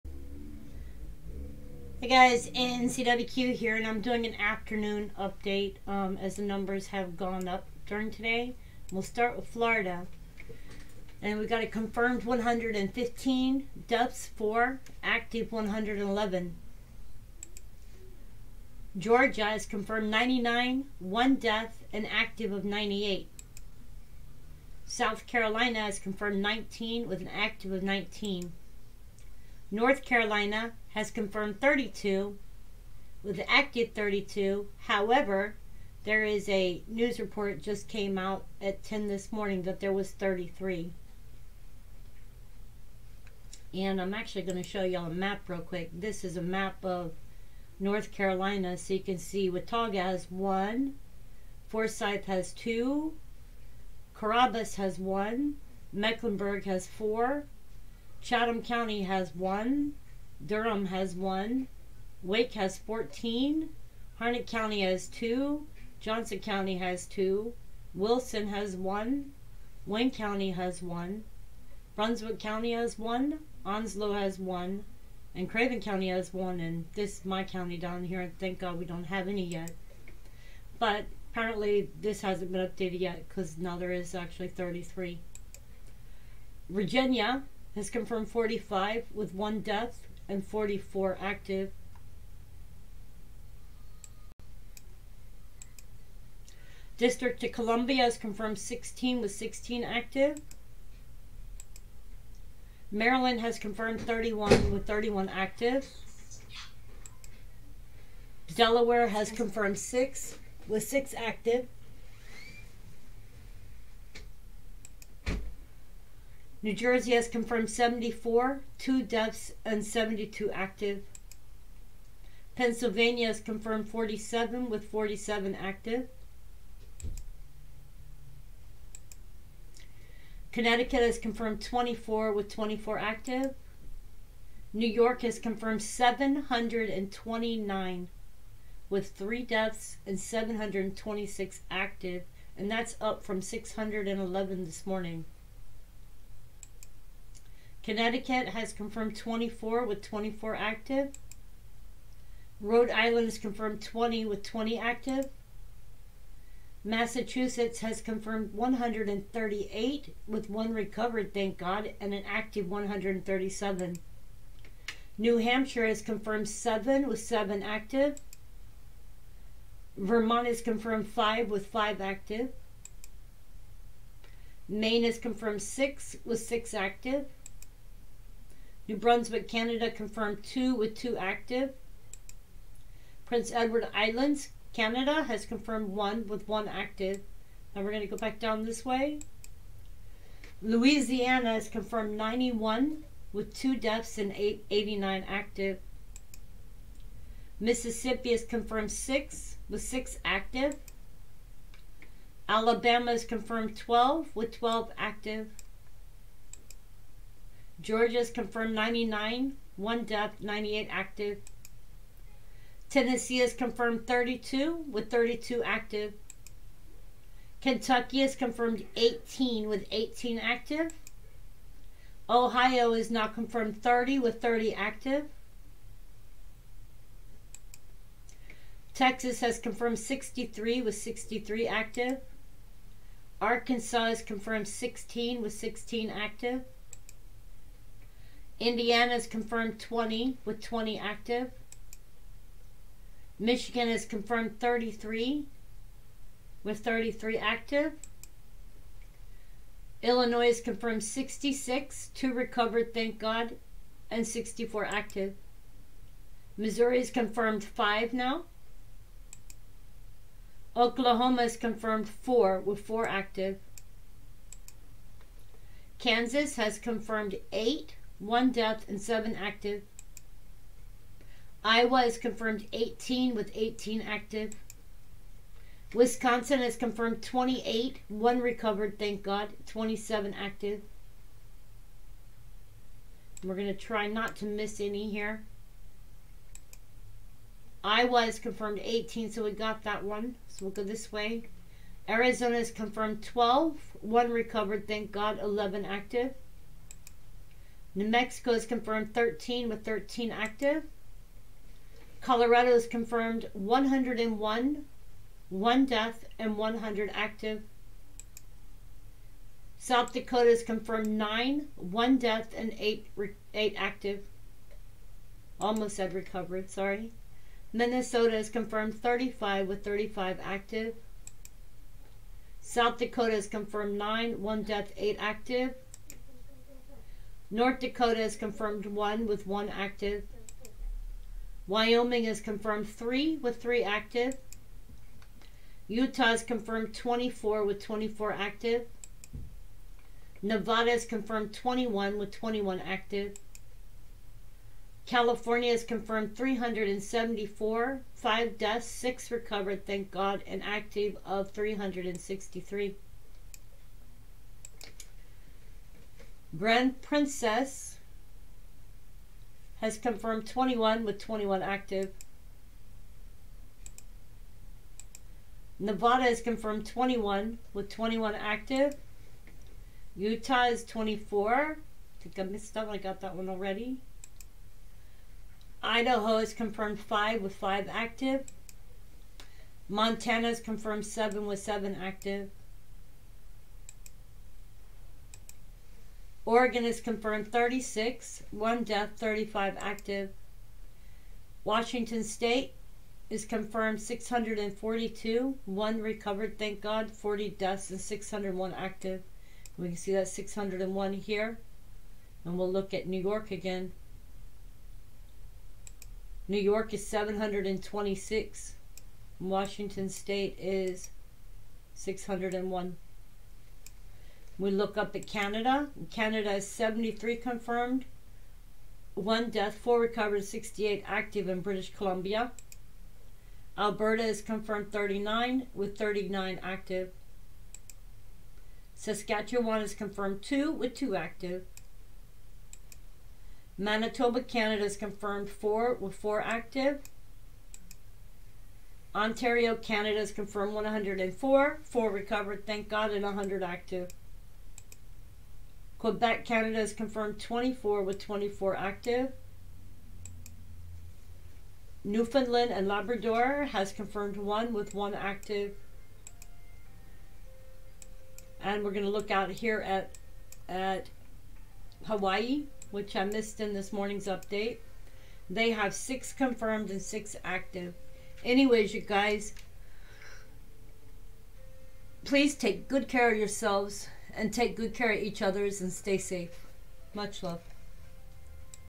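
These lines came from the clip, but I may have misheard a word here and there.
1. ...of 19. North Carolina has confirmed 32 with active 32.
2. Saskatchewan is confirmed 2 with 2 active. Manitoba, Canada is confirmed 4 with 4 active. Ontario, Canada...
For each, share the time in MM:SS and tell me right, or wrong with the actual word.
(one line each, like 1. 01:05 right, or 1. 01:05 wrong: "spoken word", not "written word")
1. 00:27 right
2. 07:08 right.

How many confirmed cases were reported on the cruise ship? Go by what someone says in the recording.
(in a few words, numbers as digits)
21.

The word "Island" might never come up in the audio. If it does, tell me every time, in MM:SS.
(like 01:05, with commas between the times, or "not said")
02:32, 03:03.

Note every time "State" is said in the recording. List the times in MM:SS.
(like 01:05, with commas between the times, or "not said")
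06:32, 06:50.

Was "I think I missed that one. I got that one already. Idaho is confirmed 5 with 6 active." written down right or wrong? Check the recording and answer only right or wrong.
wrong.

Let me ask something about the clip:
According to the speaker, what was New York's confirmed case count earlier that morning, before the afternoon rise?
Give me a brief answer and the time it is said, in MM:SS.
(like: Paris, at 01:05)
611, at 02:23.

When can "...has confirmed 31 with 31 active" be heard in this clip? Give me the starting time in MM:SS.
01:43.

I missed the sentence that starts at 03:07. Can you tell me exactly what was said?
Now we're going to go back down this way.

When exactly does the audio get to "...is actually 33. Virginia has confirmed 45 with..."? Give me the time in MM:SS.
01:23.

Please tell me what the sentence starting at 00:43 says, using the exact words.
And I'm actually going to show y'all a map real quick.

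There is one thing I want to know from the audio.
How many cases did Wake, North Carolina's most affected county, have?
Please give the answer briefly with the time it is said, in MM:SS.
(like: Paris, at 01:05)
14, at 01:02.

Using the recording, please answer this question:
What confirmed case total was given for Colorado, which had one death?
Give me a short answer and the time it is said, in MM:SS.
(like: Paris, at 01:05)
101, at 05:03.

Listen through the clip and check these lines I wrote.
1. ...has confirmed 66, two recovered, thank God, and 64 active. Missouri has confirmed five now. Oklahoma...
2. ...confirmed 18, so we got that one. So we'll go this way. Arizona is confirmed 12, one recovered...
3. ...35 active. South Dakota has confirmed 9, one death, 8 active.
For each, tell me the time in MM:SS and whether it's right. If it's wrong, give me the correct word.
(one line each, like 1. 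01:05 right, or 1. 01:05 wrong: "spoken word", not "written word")
1. 04:10 right
2. 04:48 right
3. 05:19 right.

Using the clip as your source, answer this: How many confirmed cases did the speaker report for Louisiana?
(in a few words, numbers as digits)
91.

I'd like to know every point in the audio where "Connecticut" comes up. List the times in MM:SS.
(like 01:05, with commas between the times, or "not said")
02:10, 02:27.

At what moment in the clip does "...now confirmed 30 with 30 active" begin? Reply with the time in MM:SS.
03:43.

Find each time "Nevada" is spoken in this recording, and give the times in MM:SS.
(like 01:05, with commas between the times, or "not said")
05:40, 06:05.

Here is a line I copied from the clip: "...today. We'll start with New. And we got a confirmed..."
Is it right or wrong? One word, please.
wrong.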